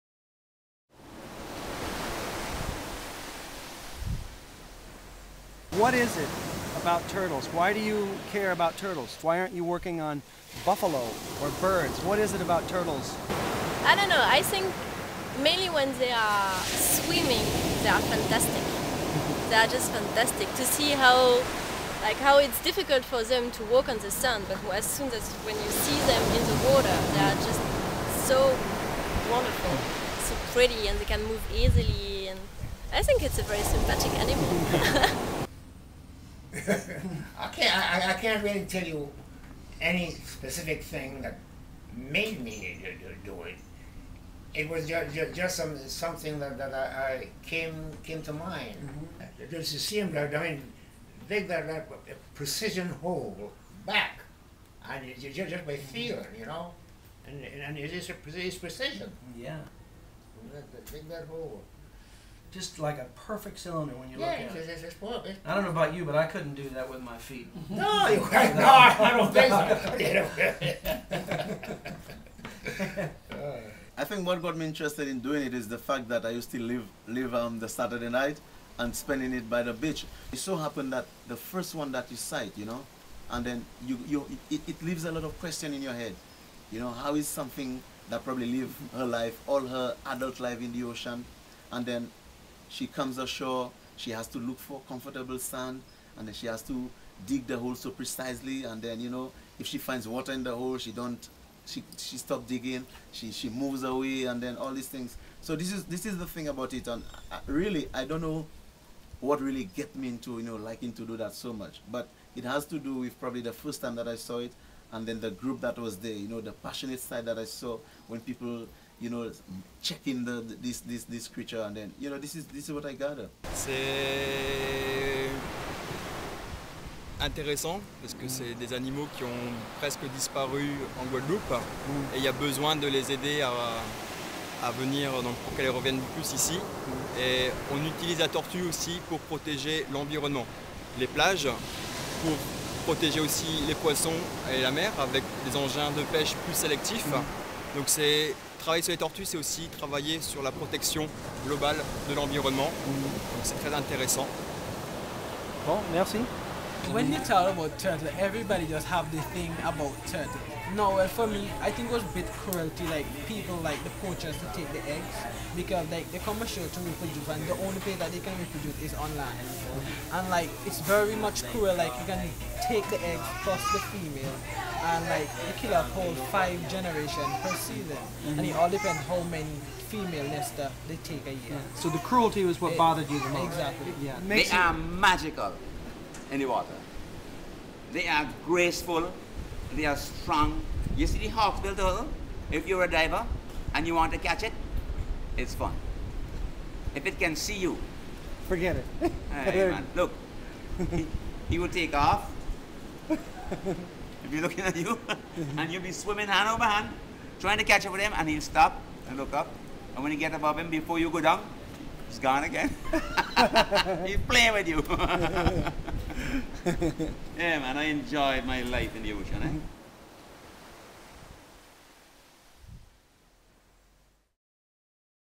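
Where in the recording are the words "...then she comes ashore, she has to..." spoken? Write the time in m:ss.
1:31.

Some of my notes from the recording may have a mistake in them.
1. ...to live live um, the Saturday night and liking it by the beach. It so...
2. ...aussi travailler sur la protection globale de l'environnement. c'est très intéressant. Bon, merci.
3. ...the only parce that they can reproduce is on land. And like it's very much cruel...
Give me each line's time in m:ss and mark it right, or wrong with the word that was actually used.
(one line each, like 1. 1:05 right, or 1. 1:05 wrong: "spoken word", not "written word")
1. 1:16 wrong: "spending", not "liking"
2. 2:29 right
3. 2:47 wrong: "place", not "parce".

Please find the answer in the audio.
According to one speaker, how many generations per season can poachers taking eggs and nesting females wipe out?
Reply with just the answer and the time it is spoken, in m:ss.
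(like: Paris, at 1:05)
5, at 2:56.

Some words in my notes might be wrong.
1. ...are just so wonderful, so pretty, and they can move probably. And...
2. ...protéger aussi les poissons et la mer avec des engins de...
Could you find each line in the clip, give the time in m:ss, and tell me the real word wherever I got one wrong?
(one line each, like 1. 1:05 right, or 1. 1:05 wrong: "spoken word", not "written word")
1. 0:27 wrong: "easily", not "probably"
2. 2:22 right.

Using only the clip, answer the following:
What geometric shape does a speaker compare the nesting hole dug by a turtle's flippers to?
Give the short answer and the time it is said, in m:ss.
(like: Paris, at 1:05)
a perfect cylinder, at 1:03.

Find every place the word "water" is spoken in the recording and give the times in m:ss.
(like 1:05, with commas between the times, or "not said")
0:26, 1:40, 3:06.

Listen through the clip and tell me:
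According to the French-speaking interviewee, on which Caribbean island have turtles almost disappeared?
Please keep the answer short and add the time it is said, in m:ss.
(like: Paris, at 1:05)
Guadeloupe, at 2:11.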